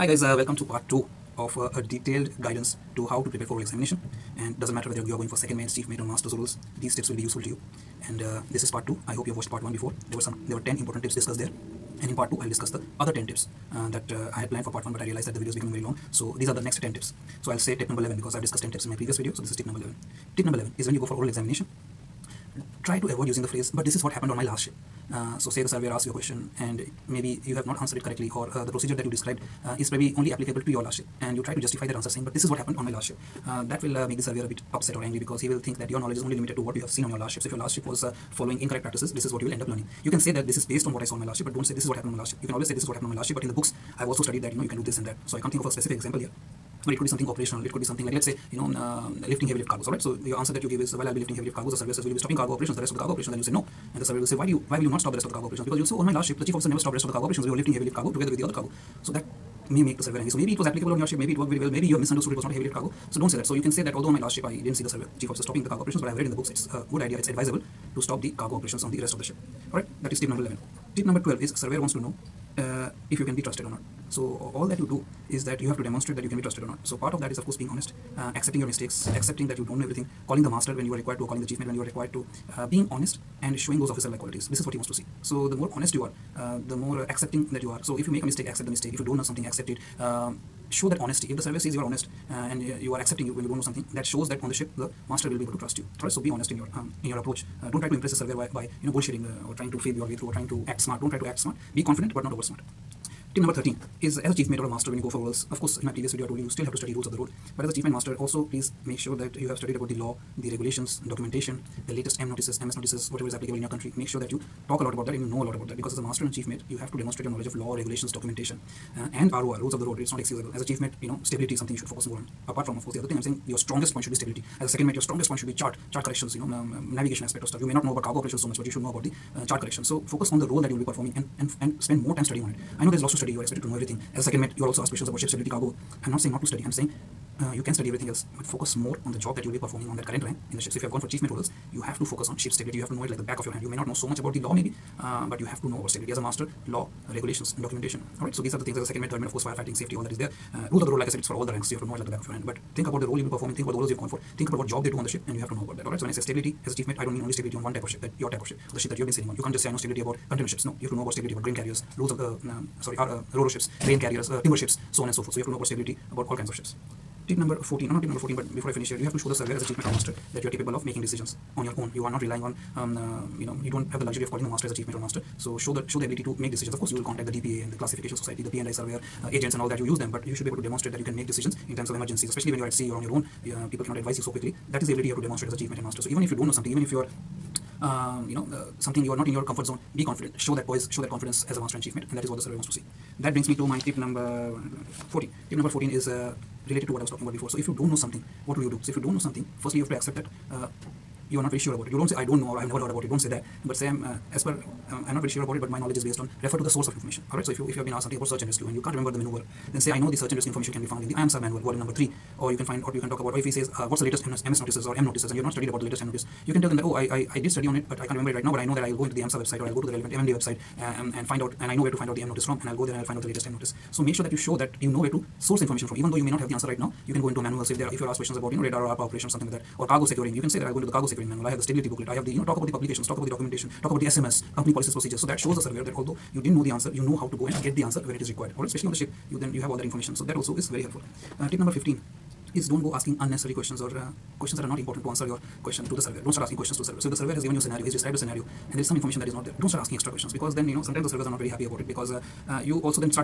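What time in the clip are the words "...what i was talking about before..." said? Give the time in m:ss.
3:16.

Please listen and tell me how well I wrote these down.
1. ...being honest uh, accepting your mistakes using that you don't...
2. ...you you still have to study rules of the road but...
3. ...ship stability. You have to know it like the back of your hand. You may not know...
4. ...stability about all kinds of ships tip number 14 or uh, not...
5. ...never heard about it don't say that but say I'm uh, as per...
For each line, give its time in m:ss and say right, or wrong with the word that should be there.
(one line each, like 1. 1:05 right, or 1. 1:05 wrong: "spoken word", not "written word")
1. 1:17 wrong: "accepting", not "using"
2. 1:46 right
3. 2:22 right
4. 2:45 right
5. 3:22 right.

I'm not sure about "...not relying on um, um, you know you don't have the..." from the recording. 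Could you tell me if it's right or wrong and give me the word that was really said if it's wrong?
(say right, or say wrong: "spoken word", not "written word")
right.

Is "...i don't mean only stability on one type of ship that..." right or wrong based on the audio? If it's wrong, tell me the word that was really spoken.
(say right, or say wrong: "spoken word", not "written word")
right.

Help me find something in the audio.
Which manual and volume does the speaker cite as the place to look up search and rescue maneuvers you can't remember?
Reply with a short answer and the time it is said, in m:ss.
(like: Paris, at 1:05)
IAMSAR manual volume 3, at 3:31.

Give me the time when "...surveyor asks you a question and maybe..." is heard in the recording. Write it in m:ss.
0:25.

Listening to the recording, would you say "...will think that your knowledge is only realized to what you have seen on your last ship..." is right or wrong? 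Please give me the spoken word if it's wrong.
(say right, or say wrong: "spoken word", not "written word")
wrong: "limited", not "realized".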